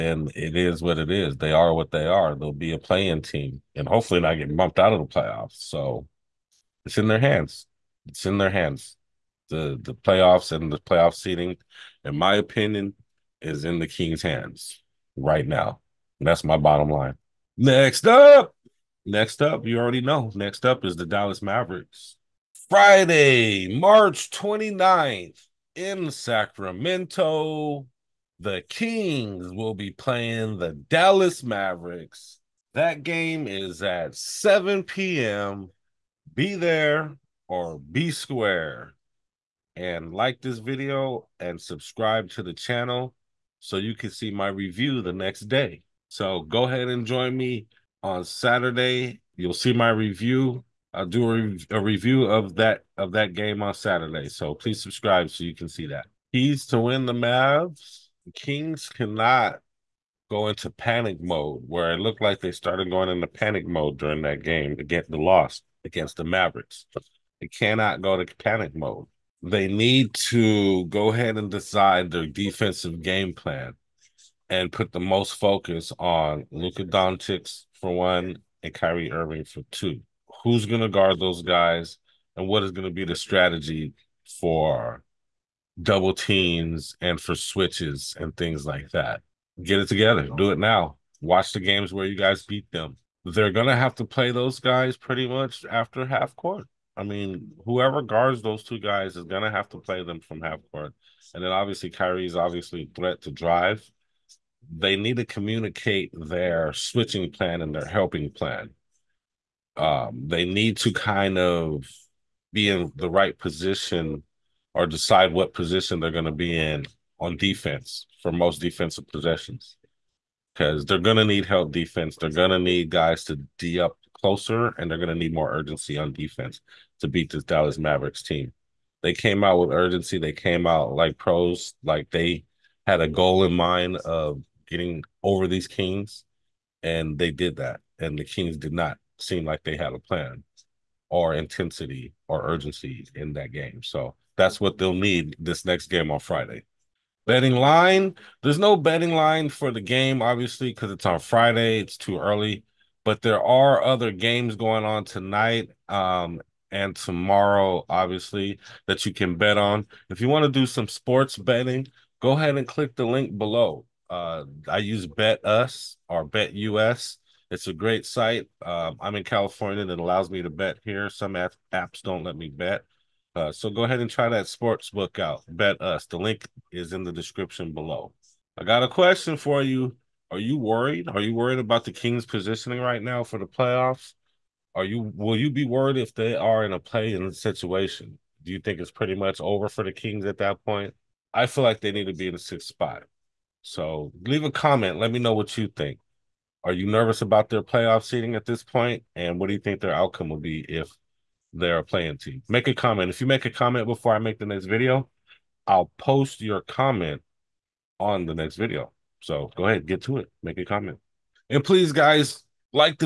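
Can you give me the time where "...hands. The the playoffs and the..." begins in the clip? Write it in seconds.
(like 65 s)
8 s.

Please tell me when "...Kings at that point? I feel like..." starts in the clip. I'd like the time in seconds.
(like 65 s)
189 s.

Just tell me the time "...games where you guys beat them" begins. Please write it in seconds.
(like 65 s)
91 s.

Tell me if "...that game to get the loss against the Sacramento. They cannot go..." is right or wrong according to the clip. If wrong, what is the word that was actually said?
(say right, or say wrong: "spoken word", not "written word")
wrong: "Mavericks", not "Sacramento".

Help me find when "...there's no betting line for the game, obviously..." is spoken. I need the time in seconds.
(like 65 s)
148 s.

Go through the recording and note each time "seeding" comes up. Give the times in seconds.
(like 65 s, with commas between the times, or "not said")
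198 s.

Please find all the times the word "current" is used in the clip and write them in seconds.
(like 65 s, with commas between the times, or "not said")
not said.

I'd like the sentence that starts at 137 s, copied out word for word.
And the Kings did not seem like they had a plan or intensity or urgency in that game.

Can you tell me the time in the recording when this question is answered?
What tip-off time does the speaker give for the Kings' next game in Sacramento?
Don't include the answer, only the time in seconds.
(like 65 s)
34 s.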